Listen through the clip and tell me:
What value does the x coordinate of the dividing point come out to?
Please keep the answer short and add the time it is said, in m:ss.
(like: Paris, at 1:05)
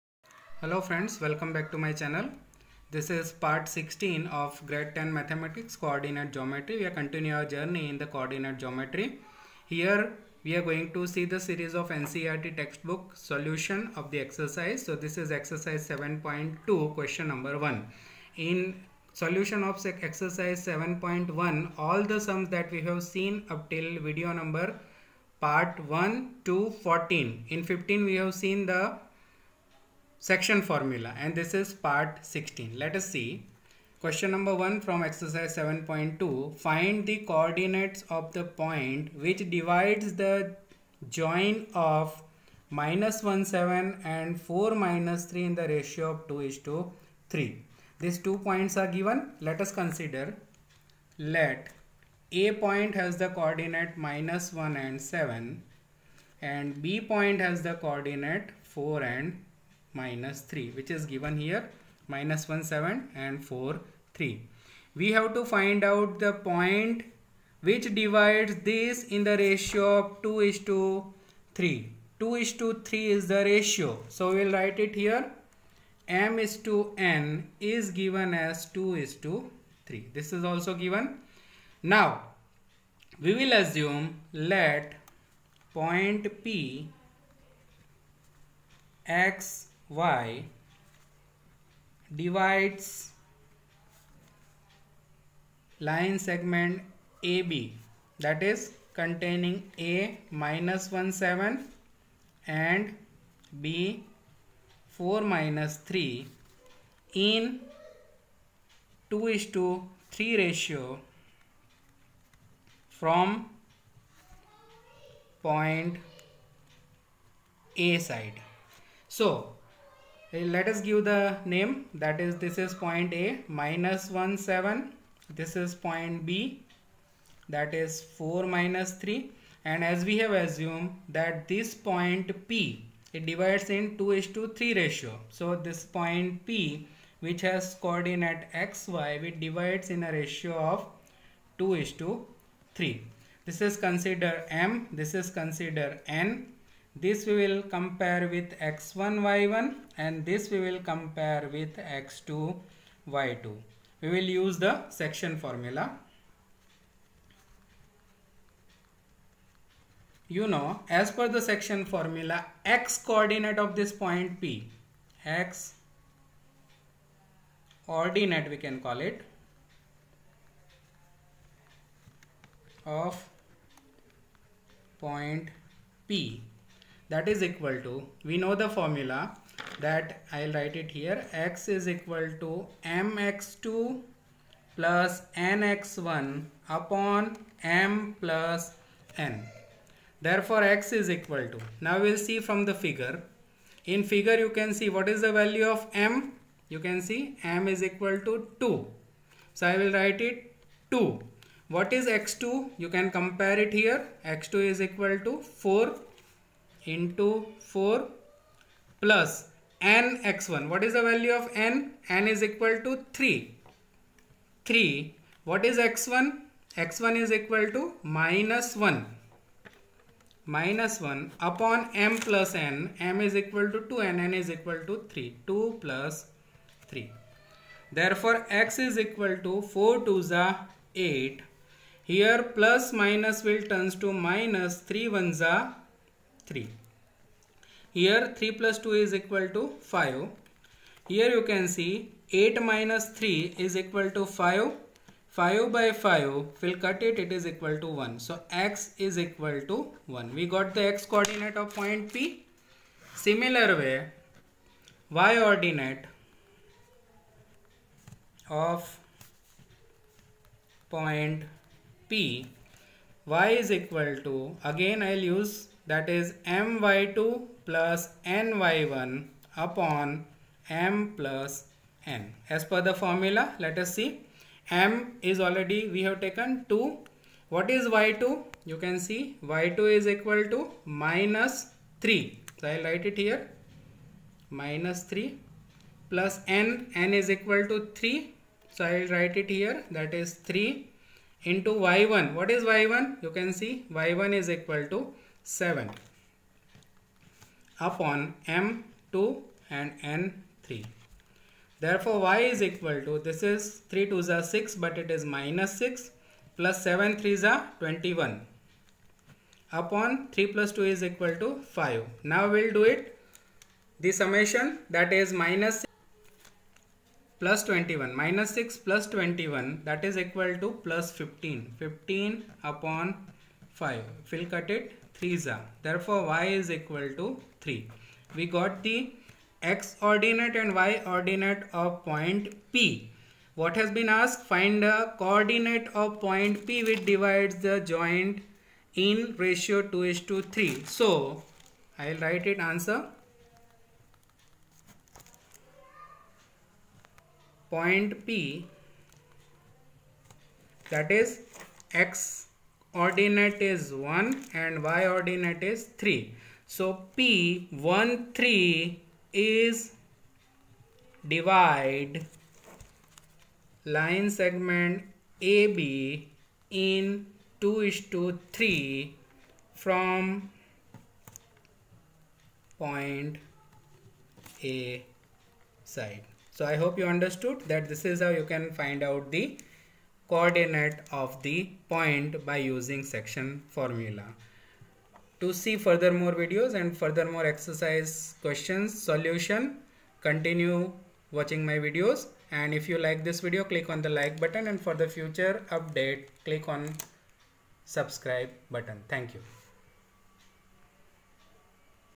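1, at 4:08.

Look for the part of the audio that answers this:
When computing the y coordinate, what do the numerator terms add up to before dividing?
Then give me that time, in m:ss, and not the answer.
5:20.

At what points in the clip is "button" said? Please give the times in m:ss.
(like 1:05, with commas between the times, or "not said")
6:34, 6:38.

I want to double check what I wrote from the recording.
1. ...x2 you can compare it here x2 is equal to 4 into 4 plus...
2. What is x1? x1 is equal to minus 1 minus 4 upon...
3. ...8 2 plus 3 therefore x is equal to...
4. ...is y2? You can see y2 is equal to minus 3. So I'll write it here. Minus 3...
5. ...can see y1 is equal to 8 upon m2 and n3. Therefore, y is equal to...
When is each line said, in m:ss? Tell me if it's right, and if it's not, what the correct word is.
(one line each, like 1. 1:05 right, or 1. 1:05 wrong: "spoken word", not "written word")
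1. 3:22 right
2. 3:35 wrong: "1", not "4"
3. 3:45 wrong: "3", not "8"
4. 4:37 right
5. 4:53 wrong: "7", not "8".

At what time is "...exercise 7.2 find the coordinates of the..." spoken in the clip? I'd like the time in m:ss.
0:35.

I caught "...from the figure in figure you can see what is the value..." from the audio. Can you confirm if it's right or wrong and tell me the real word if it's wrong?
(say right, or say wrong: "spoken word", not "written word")
right.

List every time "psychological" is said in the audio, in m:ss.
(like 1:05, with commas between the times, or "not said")
not said.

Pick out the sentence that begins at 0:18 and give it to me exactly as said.
In solution of exercise 7.1 all the sums that we have seen up till video number part 1 to 14.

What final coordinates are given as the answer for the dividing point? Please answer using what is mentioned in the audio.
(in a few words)
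(1, 3).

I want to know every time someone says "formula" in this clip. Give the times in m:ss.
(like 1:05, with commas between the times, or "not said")
0:30, 2:35, 2:41, 2:58, 4:33, 6:23.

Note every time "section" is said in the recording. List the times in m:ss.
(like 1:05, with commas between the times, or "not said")
0:30, 2:34, 2:41, 6:23.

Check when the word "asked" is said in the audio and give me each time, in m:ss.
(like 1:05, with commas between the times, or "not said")
5:34.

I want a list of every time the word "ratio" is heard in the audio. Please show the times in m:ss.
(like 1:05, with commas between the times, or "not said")
0:45, 1:09, 1:13, 1:50, 2:14, 2:20, 5:39.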